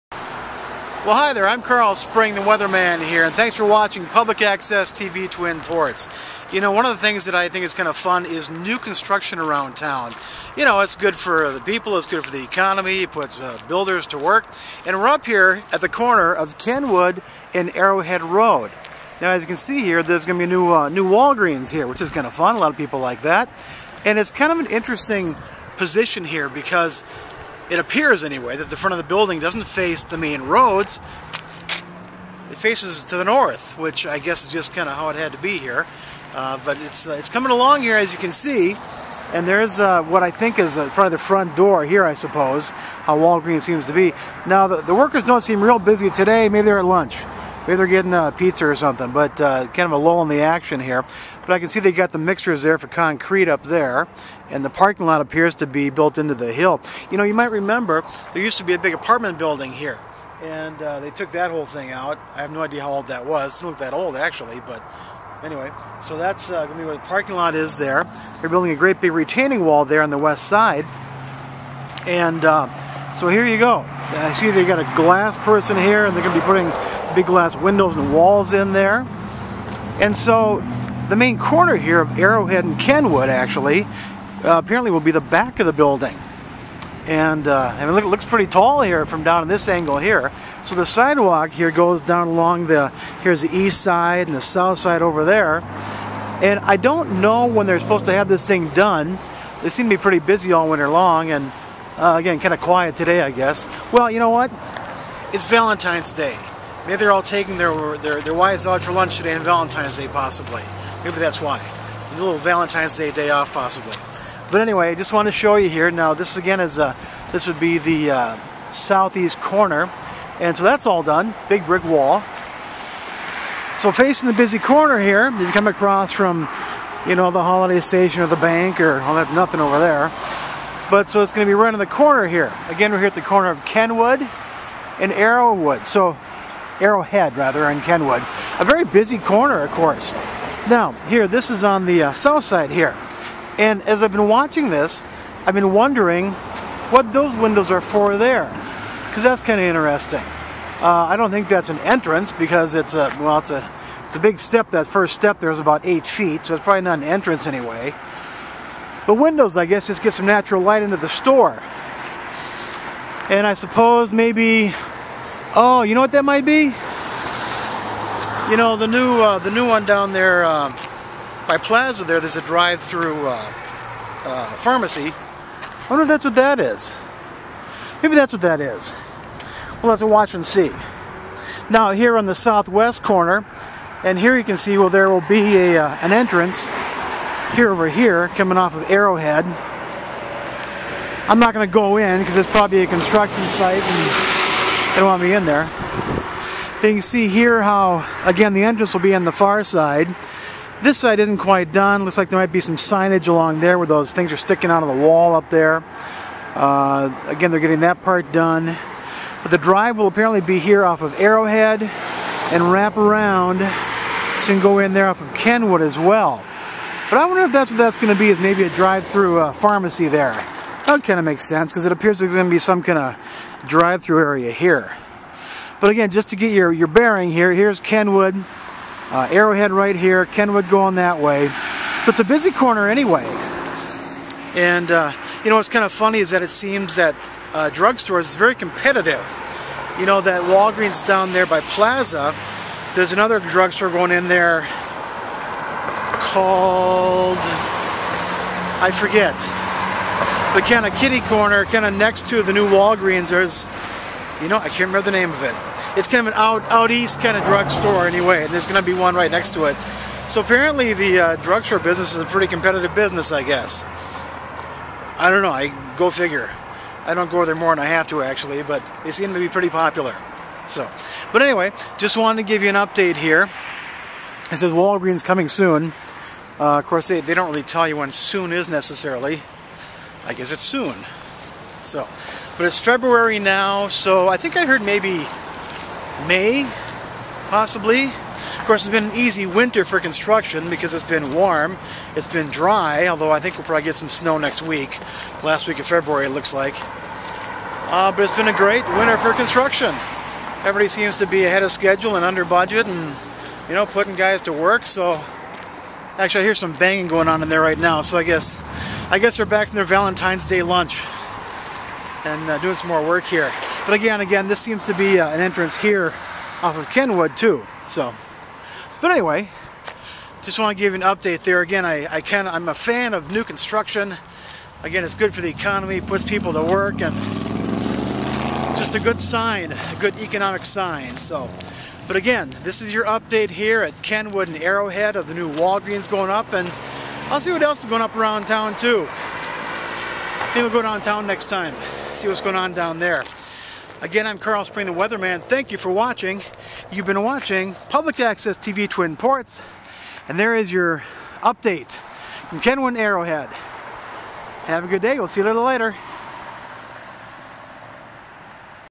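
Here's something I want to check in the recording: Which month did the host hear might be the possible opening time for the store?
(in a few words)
May.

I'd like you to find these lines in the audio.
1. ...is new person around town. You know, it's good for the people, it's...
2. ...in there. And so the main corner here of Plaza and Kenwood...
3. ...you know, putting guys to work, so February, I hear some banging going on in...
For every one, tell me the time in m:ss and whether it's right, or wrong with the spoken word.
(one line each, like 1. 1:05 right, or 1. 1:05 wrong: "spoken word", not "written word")
1. 0:08 wrong: "construction", not "person"
2. 1:18 wrong: "Arrowhead", not "Plaza"
3. 5:03 wrong: "Actually", not "February".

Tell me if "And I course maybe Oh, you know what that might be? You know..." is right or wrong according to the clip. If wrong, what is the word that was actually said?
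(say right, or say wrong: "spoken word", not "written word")
wrong: "suppose", not "course".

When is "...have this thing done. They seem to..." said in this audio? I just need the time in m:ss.
1:38.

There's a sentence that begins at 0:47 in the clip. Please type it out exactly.
Maybe they're getting a uh, pizza or something, but uh, kind of a lull in the action here.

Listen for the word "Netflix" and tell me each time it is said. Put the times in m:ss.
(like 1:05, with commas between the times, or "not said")
not said.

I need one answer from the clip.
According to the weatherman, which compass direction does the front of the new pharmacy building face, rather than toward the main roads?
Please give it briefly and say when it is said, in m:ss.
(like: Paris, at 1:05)
North, at 0:32.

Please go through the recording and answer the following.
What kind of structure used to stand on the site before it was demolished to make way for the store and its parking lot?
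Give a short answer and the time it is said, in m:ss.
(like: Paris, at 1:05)
Apartment building, at 0:58.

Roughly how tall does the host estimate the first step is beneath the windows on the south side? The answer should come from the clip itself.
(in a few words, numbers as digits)
8 feet.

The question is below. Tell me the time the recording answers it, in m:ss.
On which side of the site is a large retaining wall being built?
1:10.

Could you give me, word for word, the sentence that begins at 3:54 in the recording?
And uh, you know what's kind of funny is that it seems that uh, drugstores is very competitive.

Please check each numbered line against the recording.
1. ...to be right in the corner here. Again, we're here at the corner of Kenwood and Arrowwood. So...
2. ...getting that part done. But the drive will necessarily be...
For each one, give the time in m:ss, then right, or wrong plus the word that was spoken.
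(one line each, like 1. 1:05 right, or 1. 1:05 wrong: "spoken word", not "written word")
1. 2:11 right
2. 3:27 wrong: "apparently", not "necessarily".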